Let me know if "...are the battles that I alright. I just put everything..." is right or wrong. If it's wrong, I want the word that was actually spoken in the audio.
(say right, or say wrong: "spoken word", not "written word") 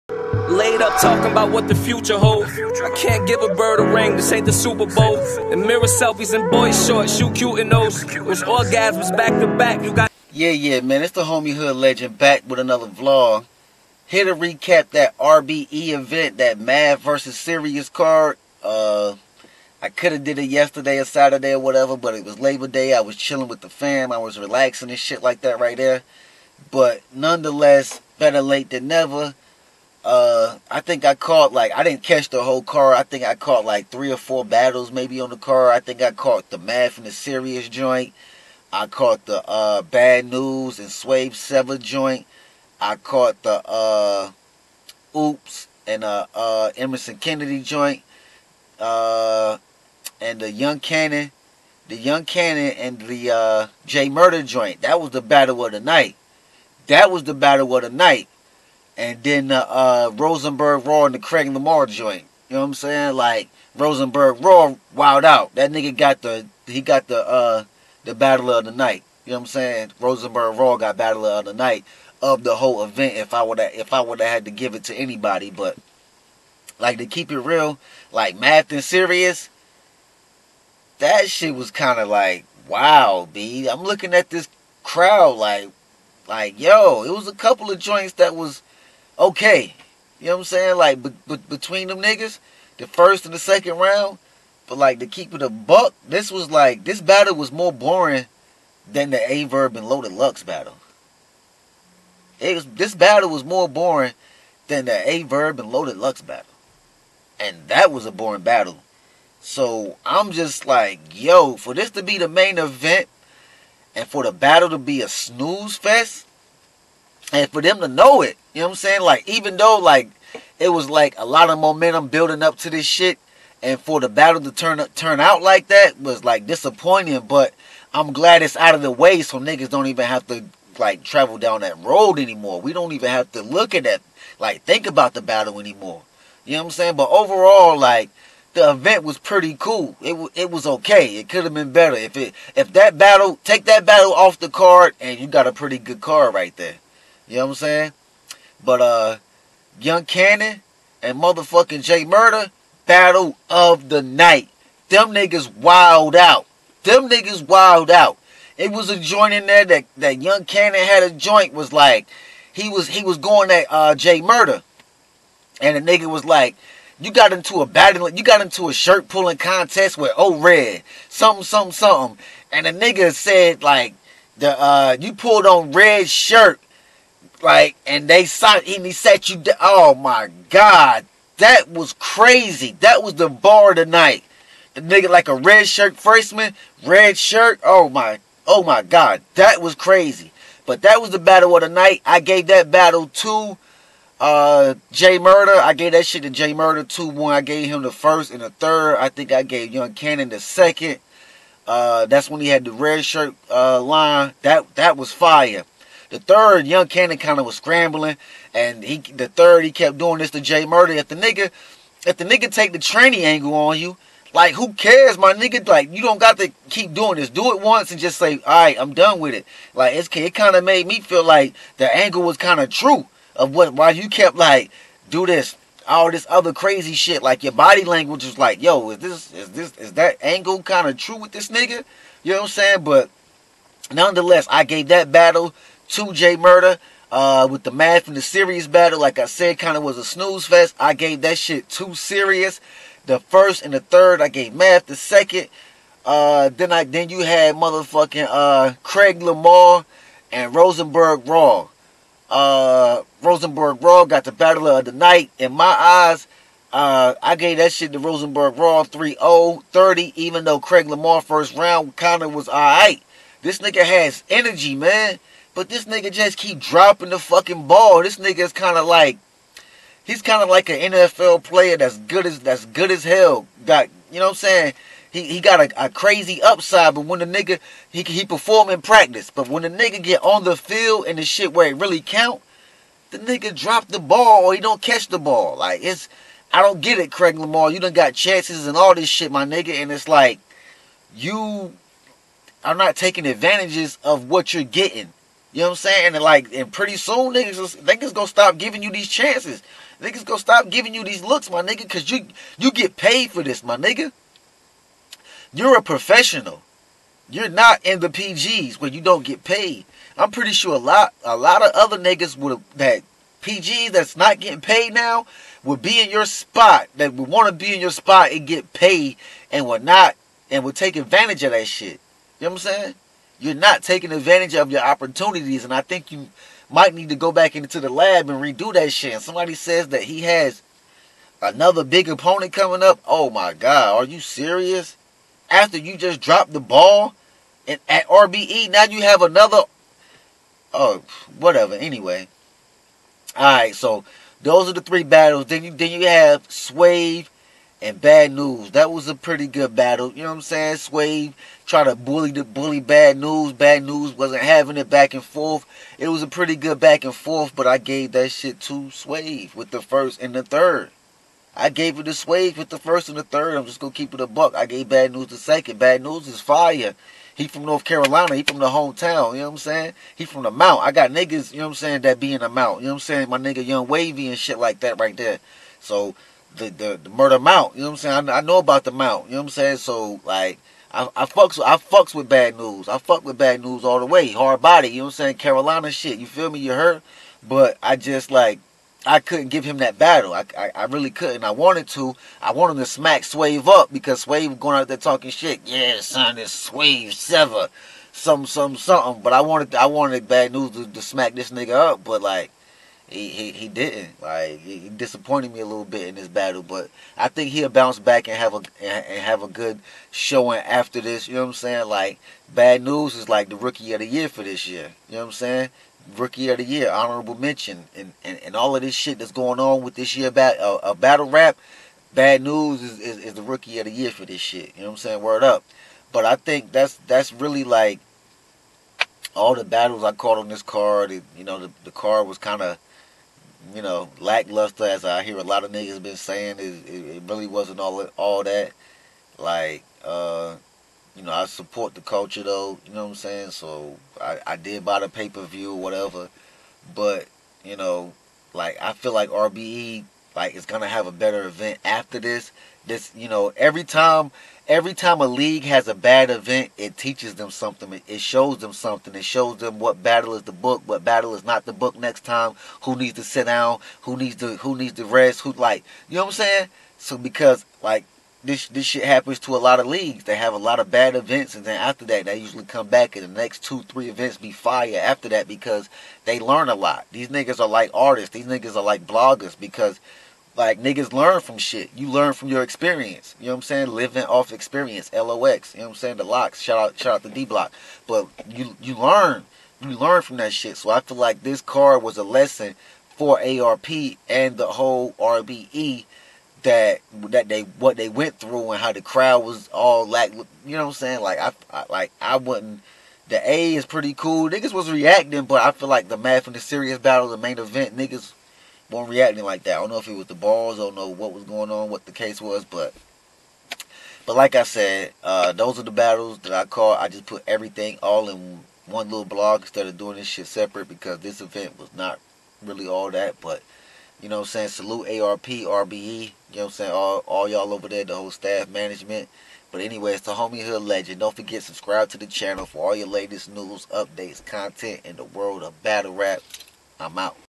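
wrong: "caught", not "alright".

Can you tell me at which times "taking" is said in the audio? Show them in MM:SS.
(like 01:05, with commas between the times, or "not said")
04:52, 05:23.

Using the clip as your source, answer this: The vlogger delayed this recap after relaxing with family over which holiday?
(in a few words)
Labor Day.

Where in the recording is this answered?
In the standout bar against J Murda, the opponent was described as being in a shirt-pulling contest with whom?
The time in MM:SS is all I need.
02:50.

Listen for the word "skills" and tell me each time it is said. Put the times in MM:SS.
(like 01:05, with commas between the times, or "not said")
not said.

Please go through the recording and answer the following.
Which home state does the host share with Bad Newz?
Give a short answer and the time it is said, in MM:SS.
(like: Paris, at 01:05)
North Carolina, at 06:07.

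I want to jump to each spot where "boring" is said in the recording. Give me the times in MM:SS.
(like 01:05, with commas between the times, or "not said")
01:37, 01:43, 01:48.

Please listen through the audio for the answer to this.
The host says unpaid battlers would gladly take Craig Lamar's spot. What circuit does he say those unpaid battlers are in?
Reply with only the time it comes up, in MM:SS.
05:08.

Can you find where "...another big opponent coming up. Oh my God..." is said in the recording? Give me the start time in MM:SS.
05:31.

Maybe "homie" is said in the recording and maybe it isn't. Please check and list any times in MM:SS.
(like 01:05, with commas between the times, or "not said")
00:11, 08:50.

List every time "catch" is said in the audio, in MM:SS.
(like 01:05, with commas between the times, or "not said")
00:32, 04:44.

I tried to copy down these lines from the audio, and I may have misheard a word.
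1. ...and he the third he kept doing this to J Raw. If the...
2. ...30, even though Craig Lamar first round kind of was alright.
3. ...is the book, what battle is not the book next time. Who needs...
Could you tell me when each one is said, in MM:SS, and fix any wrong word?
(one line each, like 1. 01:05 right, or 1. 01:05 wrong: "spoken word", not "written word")
1. 03:28 wrong: "Murda", not "Raw"
2. 04:19 right
3. 07:40 right.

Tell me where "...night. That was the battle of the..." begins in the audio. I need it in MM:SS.
00:55.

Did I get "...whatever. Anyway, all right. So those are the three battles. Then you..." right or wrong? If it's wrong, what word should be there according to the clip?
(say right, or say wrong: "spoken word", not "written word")
right.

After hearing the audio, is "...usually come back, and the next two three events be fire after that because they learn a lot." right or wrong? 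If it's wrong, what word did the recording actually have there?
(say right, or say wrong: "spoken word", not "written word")
right.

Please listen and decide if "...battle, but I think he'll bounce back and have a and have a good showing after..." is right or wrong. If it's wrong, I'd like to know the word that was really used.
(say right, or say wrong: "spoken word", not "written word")
right.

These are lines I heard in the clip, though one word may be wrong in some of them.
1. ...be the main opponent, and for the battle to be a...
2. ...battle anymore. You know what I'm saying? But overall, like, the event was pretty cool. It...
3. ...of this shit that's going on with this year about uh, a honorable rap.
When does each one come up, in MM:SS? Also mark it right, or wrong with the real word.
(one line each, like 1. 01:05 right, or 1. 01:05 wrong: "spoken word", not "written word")
1. 01:52 wrong: "event", not "opponent"
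2. 02:15 right
3. 06:58 wrong: "battle", not "honorable".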